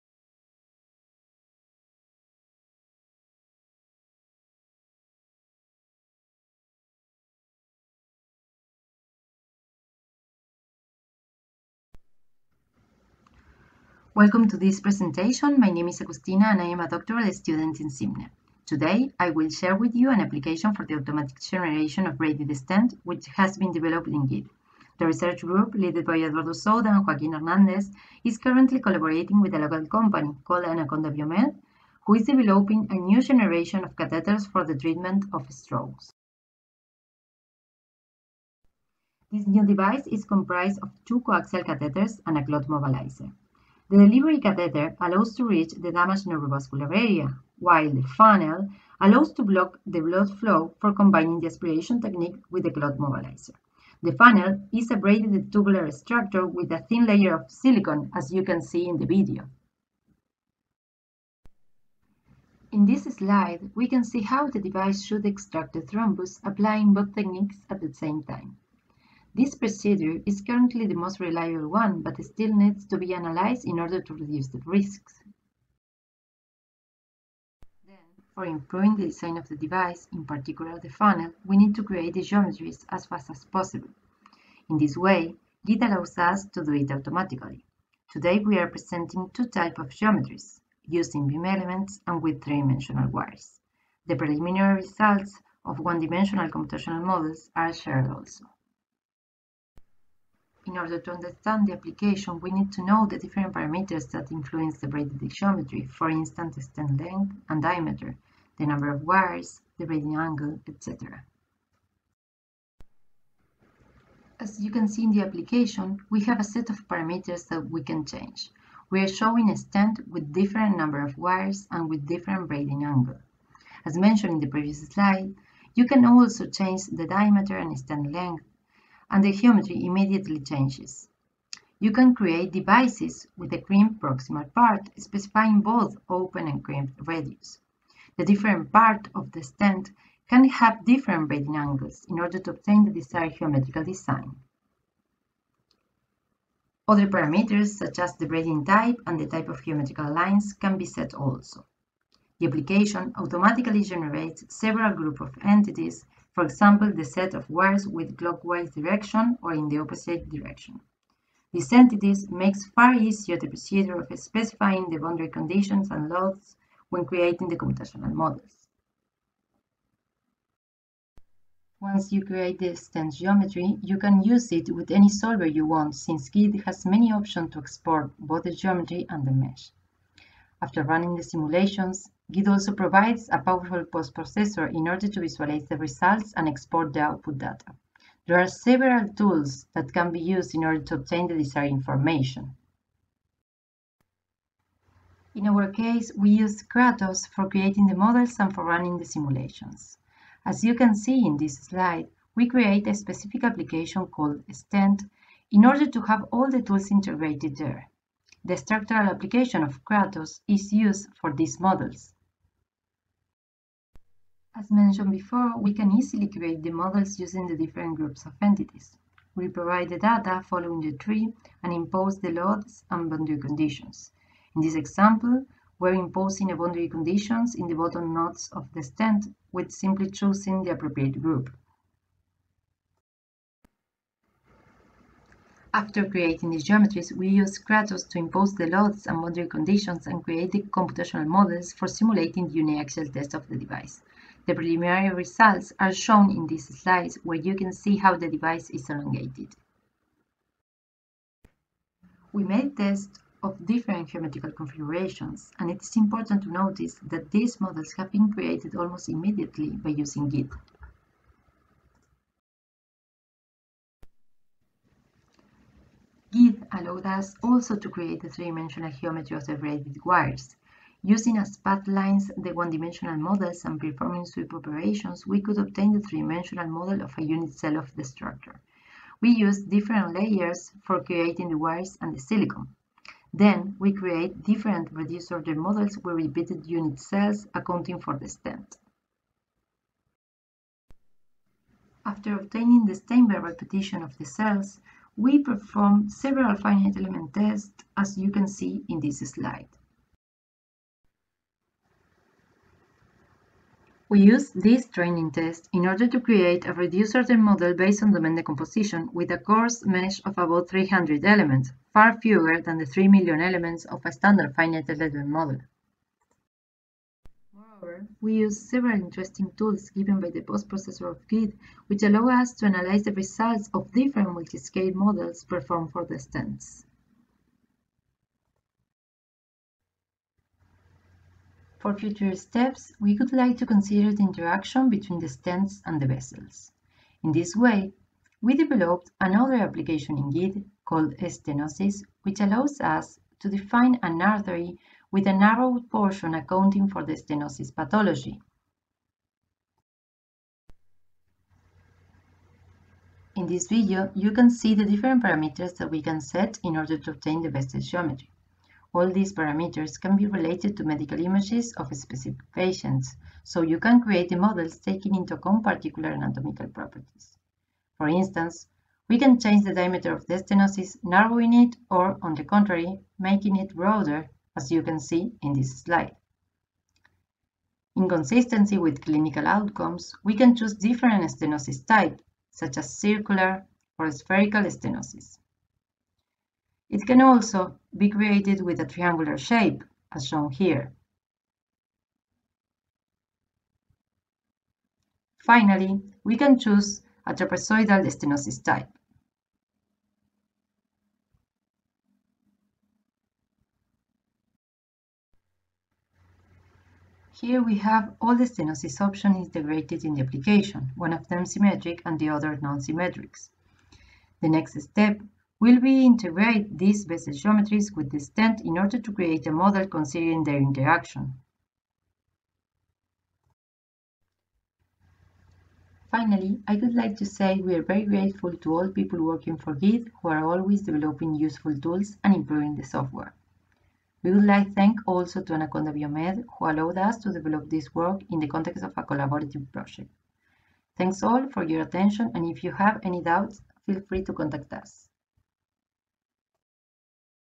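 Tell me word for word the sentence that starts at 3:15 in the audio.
In our case, we use Kratos for creating the models and for running the simulations.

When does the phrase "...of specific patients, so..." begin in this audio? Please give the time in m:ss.
6:01.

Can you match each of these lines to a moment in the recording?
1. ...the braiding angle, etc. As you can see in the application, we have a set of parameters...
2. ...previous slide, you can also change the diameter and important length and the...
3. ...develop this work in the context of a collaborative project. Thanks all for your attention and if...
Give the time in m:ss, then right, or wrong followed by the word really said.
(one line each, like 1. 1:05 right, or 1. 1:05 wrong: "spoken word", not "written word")
1. 1:49 right
2. 2:04 wrong: "stent", not "important"
3. 7:17 right.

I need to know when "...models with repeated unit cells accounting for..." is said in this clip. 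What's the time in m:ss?
4:45.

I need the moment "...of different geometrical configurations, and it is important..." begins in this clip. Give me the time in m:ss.
4:13.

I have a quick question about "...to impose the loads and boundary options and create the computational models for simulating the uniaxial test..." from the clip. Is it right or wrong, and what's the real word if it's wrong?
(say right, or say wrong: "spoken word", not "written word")
wrong: "conditions", not "options".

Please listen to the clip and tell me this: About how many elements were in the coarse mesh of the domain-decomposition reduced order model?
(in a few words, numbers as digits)
300.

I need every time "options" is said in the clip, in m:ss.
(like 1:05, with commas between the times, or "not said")
2:57, 6:48.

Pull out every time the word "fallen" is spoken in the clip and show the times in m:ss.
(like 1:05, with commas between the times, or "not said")
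not said.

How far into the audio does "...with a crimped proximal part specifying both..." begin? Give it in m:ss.
2:13.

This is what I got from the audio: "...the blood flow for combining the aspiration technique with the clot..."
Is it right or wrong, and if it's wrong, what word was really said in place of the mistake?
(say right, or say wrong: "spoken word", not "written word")
right.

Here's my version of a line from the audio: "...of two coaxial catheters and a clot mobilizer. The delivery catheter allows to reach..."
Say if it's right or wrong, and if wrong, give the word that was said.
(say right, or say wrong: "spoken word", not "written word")
right.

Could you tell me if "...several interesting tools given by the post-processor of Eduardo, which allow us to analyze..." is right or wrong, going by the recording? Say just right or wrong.
wrong.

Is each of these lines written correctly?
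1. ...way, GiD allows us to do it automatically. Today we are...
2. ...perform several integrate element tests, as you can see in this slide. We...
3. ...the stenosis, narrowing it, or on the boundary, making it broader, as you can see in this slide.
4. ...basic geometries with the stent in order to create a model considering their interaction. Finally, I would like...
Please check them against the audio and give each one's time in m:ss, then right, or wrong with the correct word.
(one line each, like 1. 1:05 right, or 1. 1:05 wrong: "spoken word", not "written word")
1. 1:24 right
2. 4:55 wrong: "finite", not "integrate"
3. 6:10 wrong: "contrary", not "boundary"
4. 6:57 right.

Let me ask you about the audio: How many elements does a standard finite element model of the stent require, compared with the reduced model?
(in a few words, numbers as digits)
3 million.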